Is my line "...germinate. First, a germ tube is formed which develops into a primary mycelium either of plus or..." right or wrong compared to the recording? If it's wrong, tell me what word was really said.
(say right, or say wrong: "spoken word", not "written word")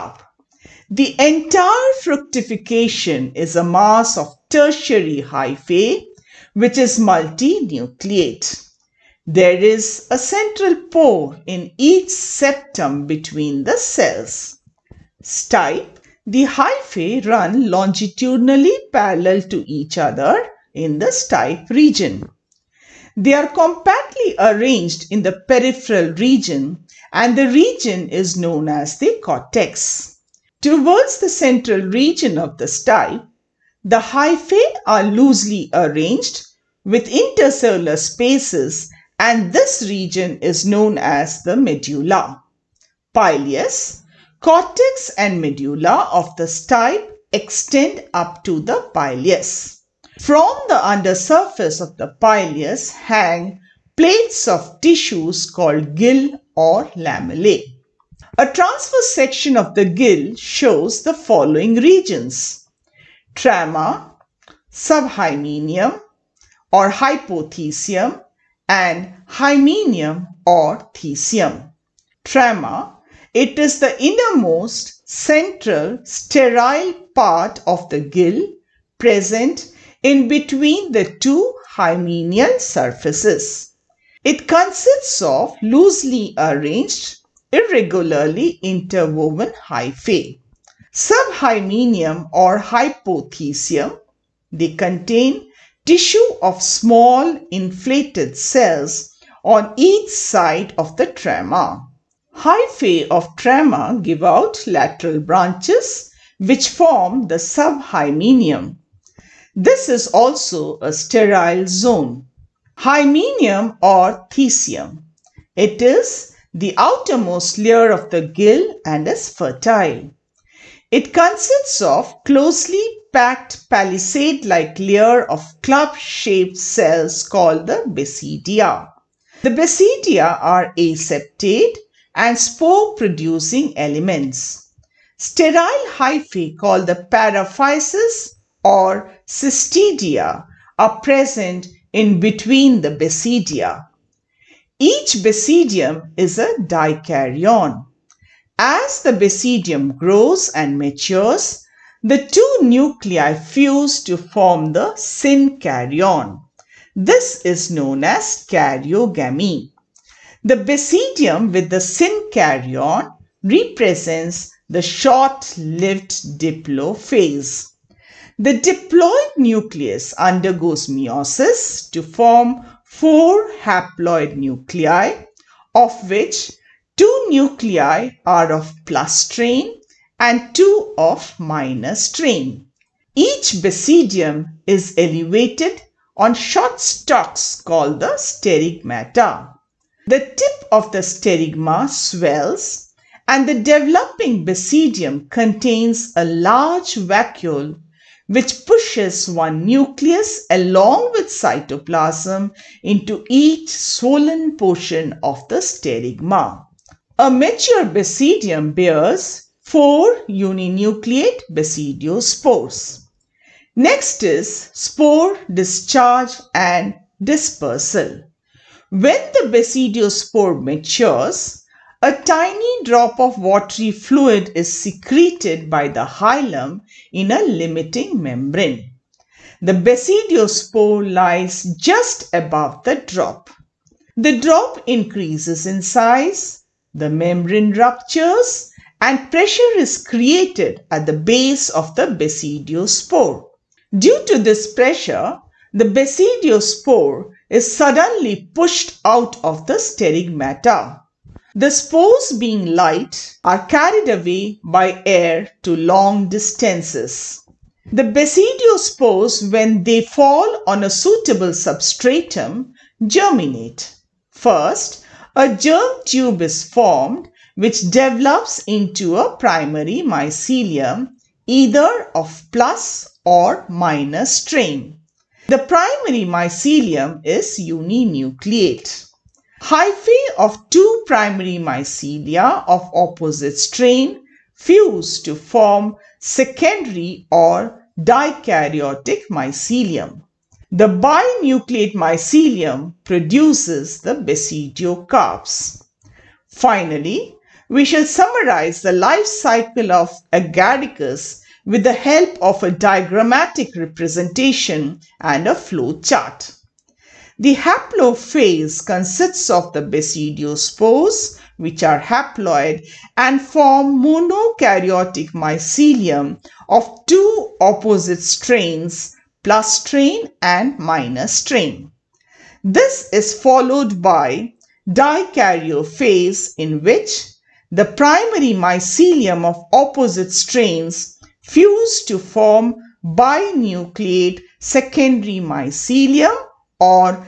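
right.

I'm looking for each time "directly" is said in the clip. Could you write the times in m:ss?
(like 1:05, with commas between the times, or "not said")
not said.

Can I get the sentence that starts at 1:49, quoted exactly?
This is also a sterile zone.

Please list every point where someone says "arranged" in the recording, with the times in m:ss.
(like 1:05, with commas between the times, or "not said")
0:24, 0:35, 1:26.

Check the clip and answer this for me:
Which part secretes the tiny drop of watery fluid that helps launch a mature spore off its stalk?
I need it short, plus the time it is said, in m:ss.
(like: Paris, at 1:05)
the hilum, at 3:46.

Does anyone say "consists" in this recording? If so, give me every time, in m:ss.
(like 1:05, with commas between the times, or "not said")
1:24, 2:01, 5:08.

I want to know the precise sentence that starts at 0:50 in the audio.
From the under surface of the pileus hang plates of tissues called gill or lamellae.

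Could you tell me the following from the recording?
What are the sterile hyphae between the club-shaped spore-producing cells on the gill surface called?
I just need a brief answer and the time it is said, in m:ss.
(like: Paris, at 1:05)
paraphysis or cystidia, at 2:17.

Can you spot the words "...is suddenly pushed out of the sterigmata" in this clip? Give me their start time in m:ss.
4:07.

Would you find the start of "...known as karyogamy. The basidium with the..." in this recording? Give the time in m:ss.
2:37.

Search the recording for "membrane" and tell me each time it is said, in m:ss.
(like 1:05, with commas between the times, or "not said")
3:48, 3:57.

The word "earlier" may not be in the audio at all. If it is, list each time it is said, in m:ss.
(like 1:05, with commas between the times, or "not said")
not said.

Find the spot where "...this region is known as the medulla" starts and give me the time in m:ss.
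0:39.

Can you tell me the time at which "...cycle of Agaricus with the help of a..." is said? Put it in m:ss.
4:59.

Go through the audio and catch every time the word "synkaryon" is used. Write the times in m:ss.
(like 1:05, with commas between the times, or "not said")
2:34, 2:41.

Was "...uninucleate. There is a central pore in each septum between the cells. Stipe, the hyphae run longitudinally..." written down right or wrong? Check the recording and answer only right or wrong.
wrong.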